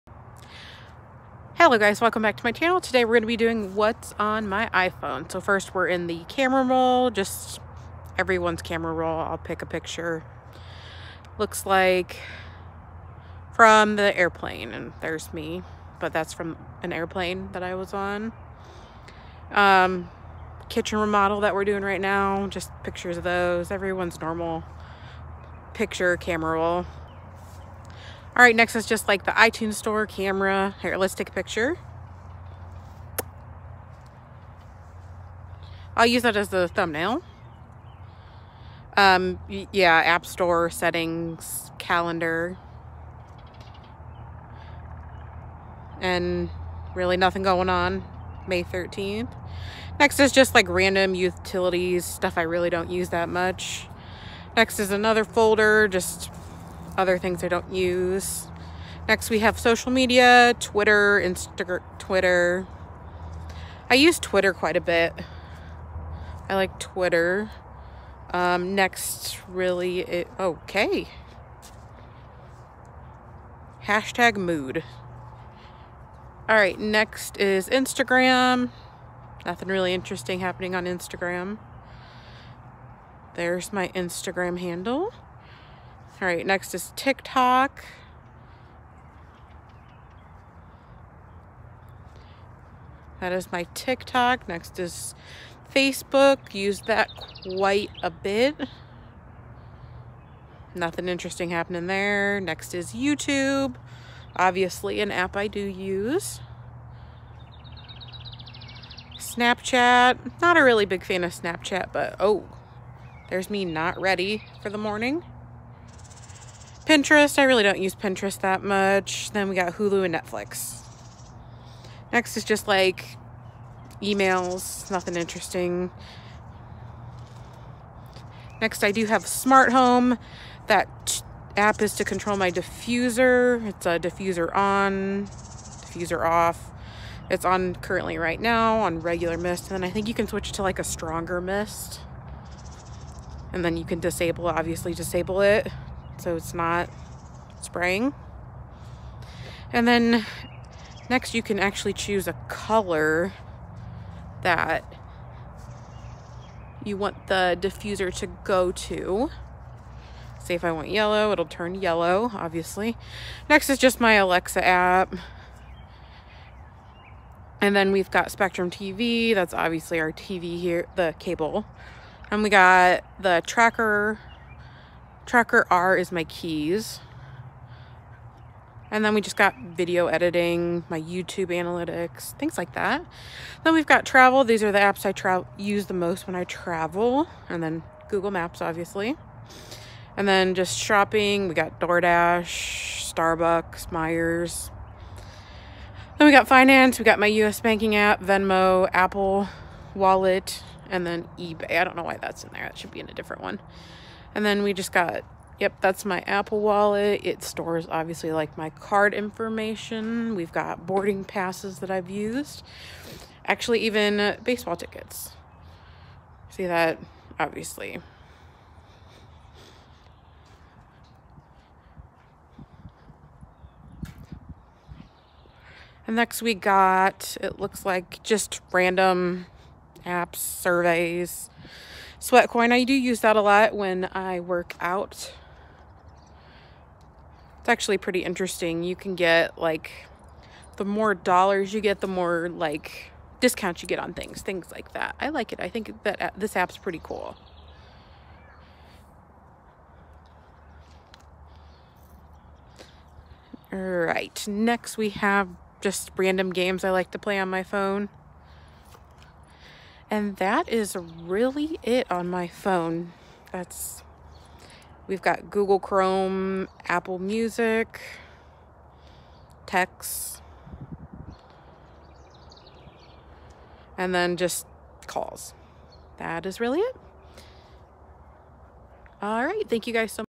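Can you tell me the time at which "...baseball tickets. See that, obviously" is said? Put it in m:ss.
3:34.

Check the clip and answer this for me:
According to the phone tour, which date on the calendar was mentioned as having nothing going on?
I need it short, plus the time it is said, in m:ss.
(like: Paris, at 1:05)
May 13th, at 0:48.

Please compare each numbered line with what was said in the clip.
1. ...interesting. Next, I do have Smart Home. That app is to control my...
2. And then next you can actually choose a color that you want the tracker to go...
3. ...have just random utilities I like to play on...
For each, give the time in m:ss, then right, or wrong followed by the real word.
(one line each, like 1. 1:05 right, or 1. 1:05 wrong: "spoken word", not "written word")
1. 2:05 right
2. 2:29 wrong: "diffuser", not "tracker"
3. 4:15 wrong: "games", not "utilities".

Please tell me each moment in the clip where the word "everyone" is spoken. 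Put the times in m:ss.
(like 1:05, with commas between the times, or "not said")
0:08, 0:23.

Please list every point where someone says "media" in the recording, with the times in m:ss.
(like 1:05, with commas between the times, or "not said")
0:59.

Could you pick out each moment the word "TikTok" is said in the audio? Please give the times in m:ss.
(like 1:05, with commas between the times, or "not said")
1:26, 1:33.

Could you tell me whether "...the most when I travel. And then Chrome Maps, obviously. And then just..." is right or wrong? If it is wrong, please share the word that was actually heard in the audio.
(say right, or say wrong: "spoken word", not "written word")
wrong: "Google", not "Chrome".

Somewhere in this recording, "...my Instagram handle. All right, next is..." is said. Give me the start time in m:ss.
1:23.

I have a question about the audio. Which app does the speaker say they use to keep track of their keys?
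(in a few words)
Tracker R.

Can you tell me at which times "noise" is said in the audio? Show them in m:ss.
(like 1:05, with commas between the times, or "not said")
not said.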